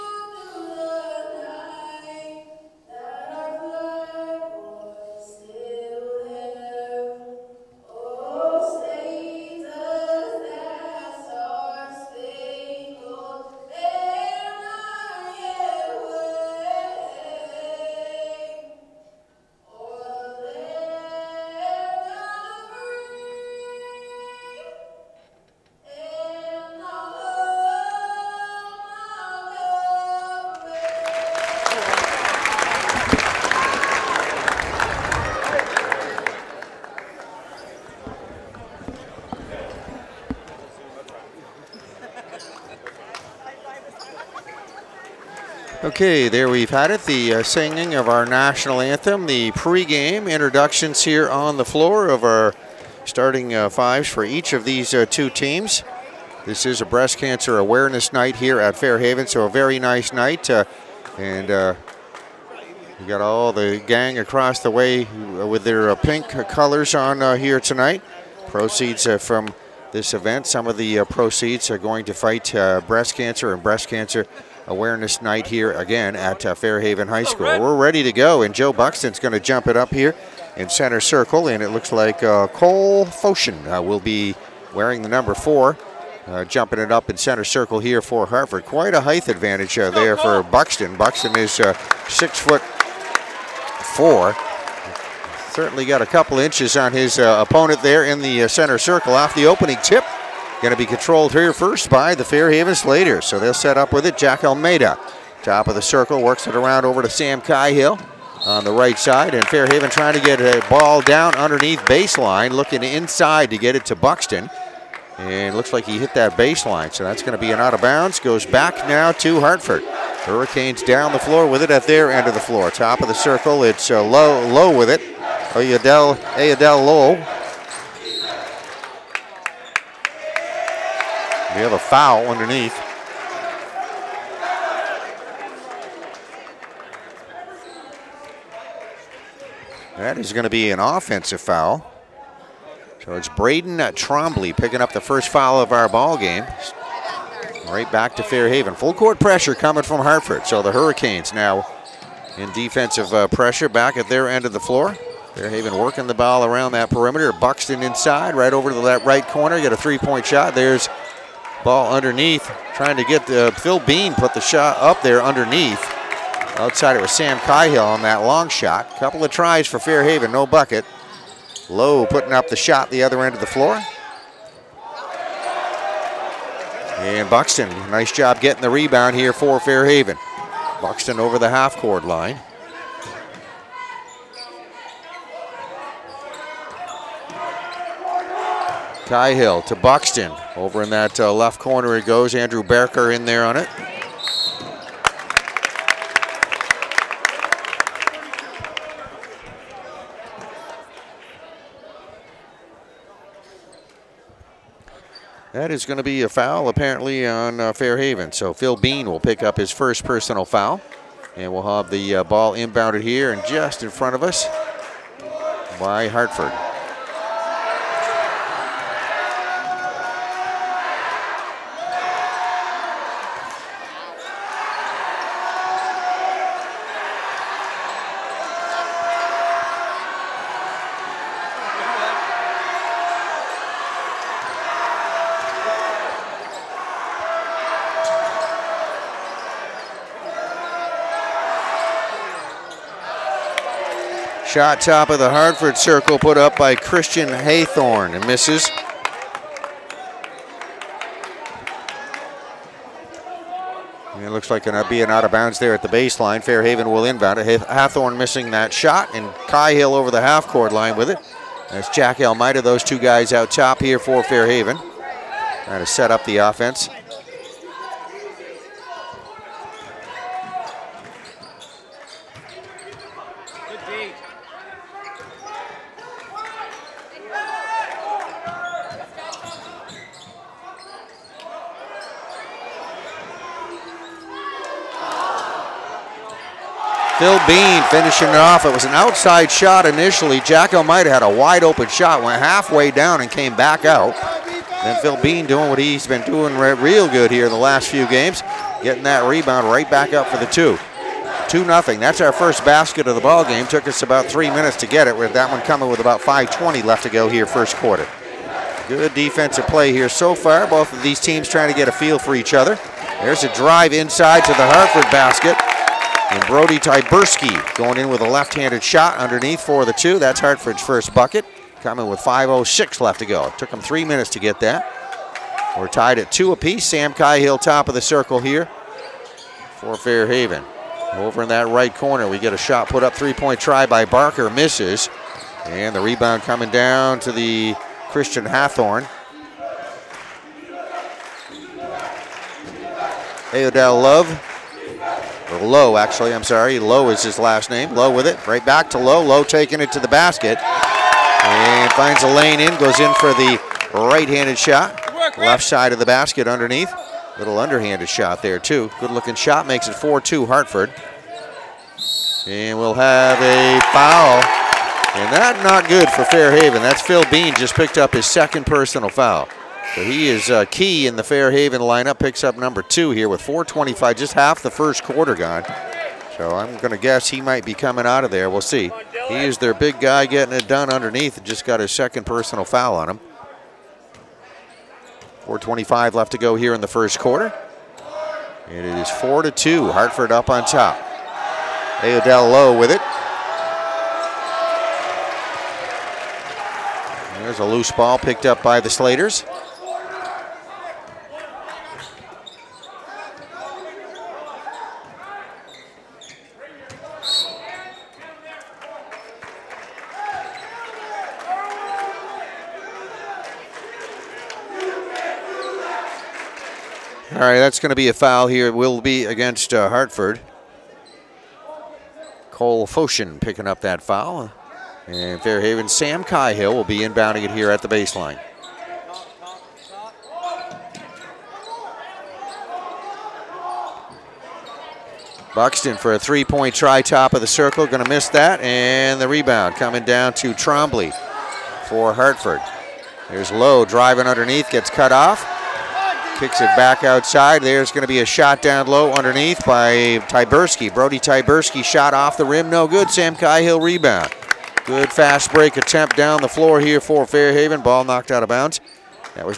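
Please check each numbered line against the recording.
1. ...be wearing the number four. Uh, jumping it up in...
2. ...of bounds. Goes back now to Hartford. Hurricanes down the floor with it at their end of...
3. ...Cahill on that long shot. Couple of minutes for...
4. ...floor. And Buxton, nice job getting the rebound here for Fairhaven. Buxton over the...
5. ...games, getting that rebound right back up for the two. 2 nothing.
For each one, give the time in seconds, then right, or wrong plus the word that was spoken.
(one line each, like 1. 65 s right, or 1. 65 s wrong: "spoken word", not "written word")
1. 84 s right
2. 117 s right
3. 167 s wrong: "tries", not "minutes"
4. 173 s right
5. 298 s right.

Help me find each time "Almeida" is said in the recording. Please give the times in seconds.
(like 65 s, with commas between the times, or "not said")
104 s, 262 s.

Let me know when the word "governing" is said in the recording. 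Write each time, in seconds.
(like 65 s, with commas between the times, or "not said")
not said.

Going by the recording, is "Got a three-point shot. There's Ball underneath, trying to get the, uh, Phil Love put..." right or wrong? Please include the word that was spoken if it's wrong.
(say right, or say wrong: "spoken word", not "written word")
wrong: "Bean", not "Love".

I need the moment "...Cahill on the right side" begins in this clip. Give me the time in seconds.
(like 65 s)
107 s.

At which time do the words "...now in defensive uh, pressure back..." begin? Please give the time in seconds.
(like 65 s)
151 s.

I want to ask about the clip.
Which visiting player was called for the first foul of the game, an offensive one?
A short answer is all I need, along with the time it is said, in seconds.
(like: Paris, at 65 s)
Braden Trombley, at 143 s.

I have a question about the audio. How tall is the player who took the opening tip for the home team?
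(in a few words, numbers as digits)
6 foot 4.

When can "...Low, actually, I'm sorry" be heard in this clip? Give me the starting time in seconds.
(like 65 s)
345 s.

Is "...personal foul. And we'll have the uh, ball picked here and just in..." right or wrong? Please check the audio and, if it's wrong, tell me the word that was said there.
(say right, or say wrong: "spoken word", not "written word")
wrong: "inbounded", not "picked".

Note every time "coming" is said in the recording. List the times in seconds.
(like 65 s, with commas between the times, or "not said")
149 s, 305 s, 321 s, 336 s, 377 s, 439 s.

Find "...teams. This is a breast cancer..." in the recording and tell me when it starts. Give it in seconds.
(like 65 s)
55 s.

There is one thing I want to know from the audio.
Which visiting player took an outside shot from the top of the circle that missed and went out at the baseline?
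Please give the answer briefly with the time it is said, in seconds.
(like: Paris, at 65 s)
Christian Haythorne, at 246 s.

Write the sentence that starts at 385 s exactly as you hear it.
425 left to go here in the first quarter.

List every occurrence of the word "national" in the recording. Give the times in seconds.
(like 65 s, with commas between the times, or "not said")
48 s.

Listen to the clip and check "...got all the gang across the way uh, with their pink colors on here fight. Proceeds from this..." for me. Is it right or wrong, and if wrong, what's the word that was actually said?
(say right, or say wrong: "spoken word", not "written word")
wrong: "tonight", not "fight".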